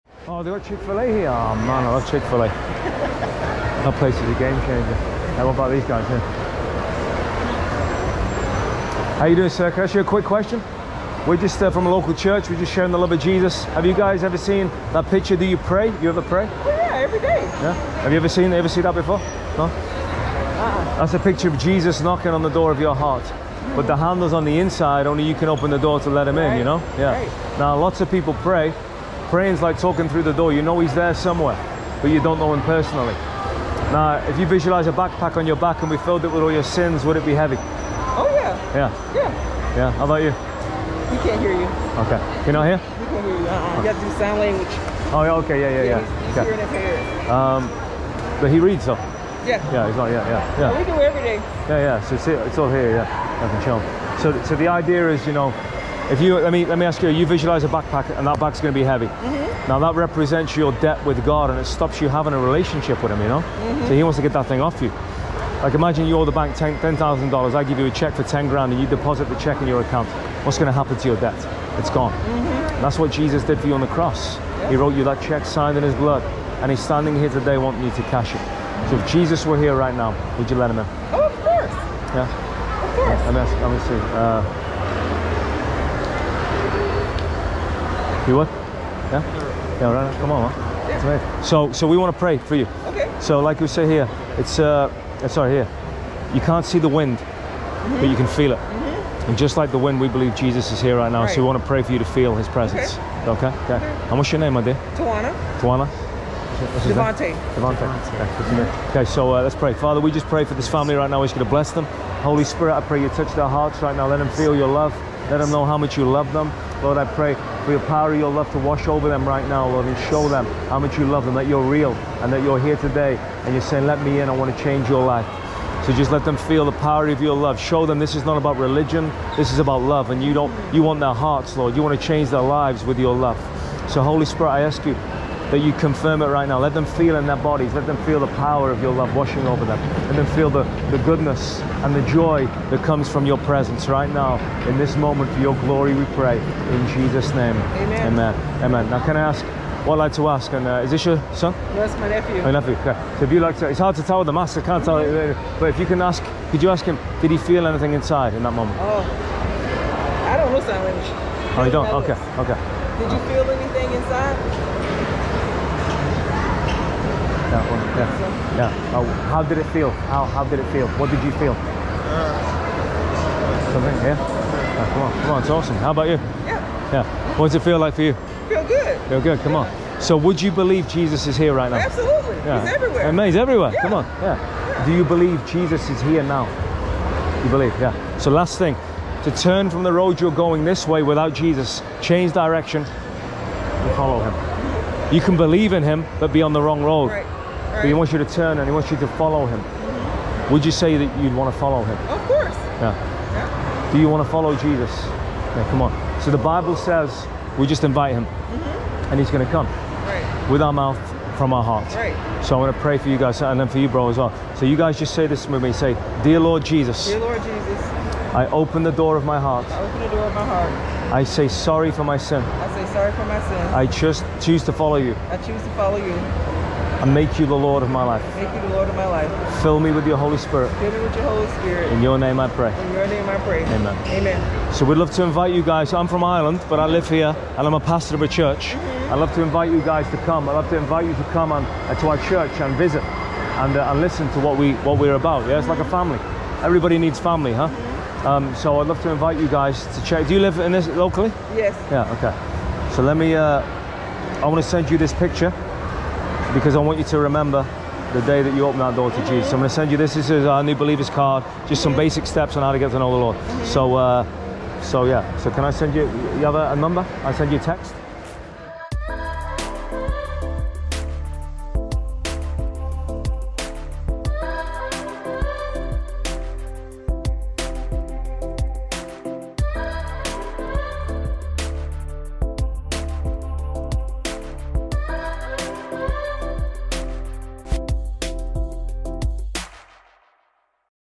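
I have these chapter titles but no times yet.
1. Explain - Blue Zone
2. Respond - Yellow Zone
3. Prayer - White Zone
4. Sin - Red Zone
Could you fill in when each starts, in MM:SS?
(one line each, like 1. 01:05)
1. 00:13
2. 01:19
3. 03:36
4. 00:33.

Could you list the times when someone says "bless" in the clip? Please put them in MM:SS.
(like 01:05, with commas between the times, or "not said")
01:51.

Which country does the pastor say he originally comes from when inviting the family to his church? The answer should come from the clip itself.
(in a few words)
Ireland.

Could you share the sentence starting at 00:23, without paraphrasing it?
But the handle's on the inside, only you can open the door to let him right.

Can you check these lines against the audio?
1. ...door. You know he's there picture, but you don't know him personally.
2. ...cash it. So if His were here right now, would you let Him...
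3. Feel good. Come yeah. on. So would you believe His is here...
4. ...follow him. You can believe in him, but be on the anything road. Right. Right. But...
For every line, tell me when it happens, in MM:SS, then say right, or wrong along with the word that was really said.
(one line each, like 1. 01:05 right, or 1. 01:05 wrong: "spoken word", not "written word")
1. 00:30 wrong: "somewhere", not "picture"
2. 01:18 wrong: "Jesus", not "His"
3. 02:59 wrong: "Jesus", not "His"
4. 03:13 wrong: "wrong", not "anything".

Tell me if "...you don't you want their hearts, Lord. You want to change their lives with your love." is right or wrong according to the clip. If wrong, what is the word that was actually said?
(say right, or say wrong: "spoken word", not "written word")
right.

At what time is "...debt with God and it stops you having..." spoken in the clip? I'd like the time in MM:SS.
01:00.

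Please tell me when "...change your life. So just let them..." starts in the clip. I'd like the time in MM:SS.
02:04.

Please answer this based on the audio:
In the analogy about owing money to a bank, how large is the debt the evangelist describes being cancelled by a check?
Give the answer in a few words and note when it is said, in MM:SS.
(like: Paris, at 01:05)
$10,000, at 01:06.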